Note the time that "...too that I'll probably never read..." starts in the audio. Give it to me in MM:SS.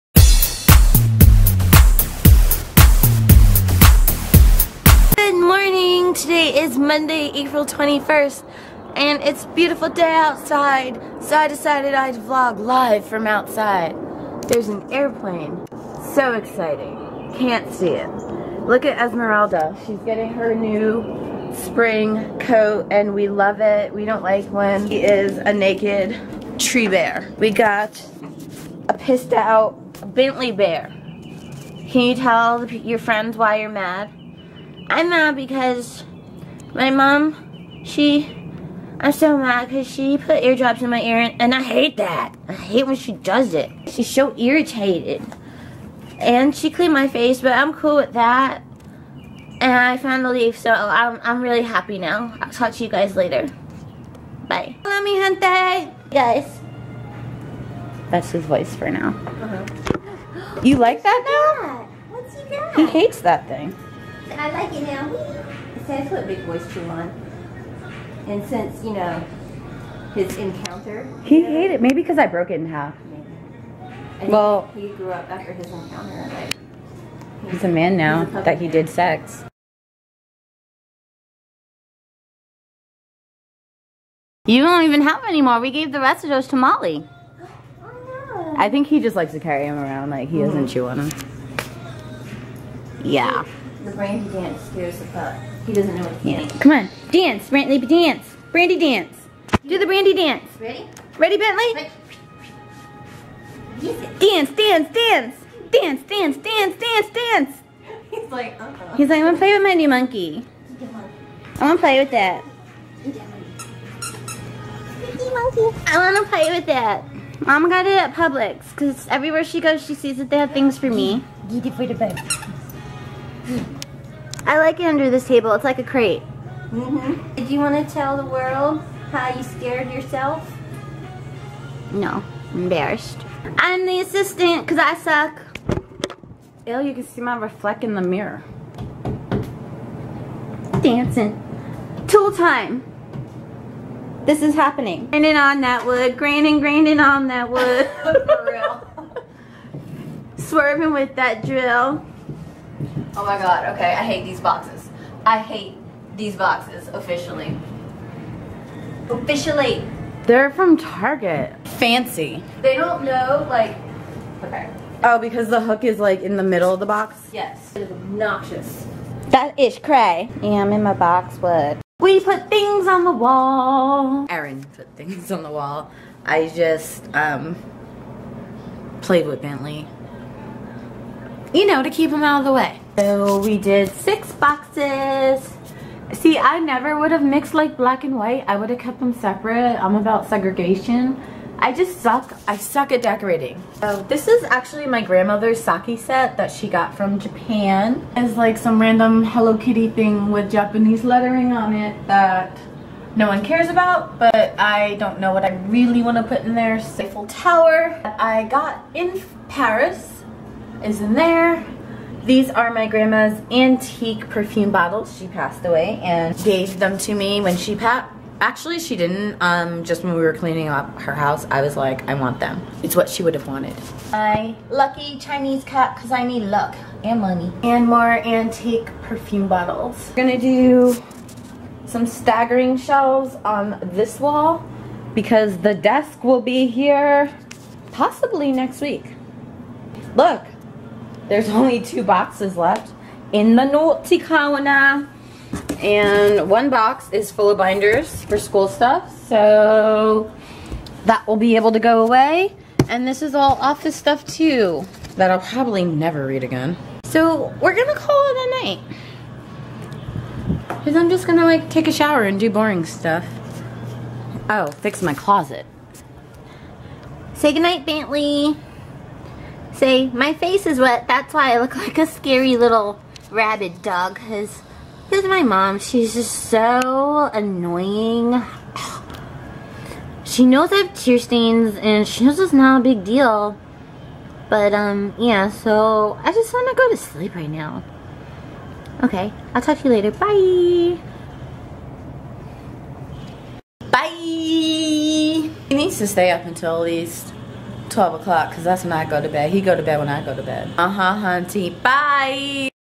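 04:14.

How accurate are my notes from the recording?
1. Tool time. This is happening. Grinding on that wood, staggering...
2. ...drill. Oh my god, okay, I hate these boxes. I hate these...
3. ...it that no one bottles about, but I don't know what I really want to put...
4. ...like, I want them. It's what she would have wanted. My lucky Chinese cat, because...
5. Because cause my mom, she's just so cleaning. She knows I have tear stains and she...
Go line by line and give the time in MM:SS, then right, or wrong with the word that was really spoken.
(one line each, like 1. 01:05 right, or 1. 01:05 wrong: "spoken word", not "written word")
1. 02:22 wrong: "grinding", not "staggering"
2. 02:31 right
3. 03:21 wrong: "cares", not "bottles"
4. 03:41 right
5. 04:34 wrong: "annoying", not "cleaning".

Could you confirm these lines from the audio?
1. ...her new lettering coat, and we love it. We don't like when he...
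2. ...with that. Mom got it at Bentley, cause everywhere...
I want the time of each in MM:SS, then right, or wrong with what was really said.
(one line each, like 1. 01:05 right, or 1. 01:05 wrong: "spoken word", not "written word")
1. 00:20 wrong: "spring", not "lettering"
2. 01:56 wrong: "Publix", not "Bentley".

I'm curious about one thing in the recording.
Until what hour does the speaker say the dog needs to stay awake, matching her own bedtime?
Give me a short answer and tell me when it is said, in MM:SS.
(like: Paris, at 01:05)
12 o'clock, at 04:57.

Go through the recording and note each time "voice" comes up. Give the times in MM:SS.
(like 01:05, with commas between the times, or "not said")
00:58, 01:06.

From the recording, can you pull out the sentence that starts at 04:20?
Cause I'm just gonna like take a shower and do boring stuff.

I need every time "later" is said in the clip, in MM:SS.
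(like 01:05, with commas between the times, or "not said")
00:53, 04:49.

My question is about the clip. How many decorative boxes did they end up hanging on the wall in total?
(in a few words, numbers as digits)
6.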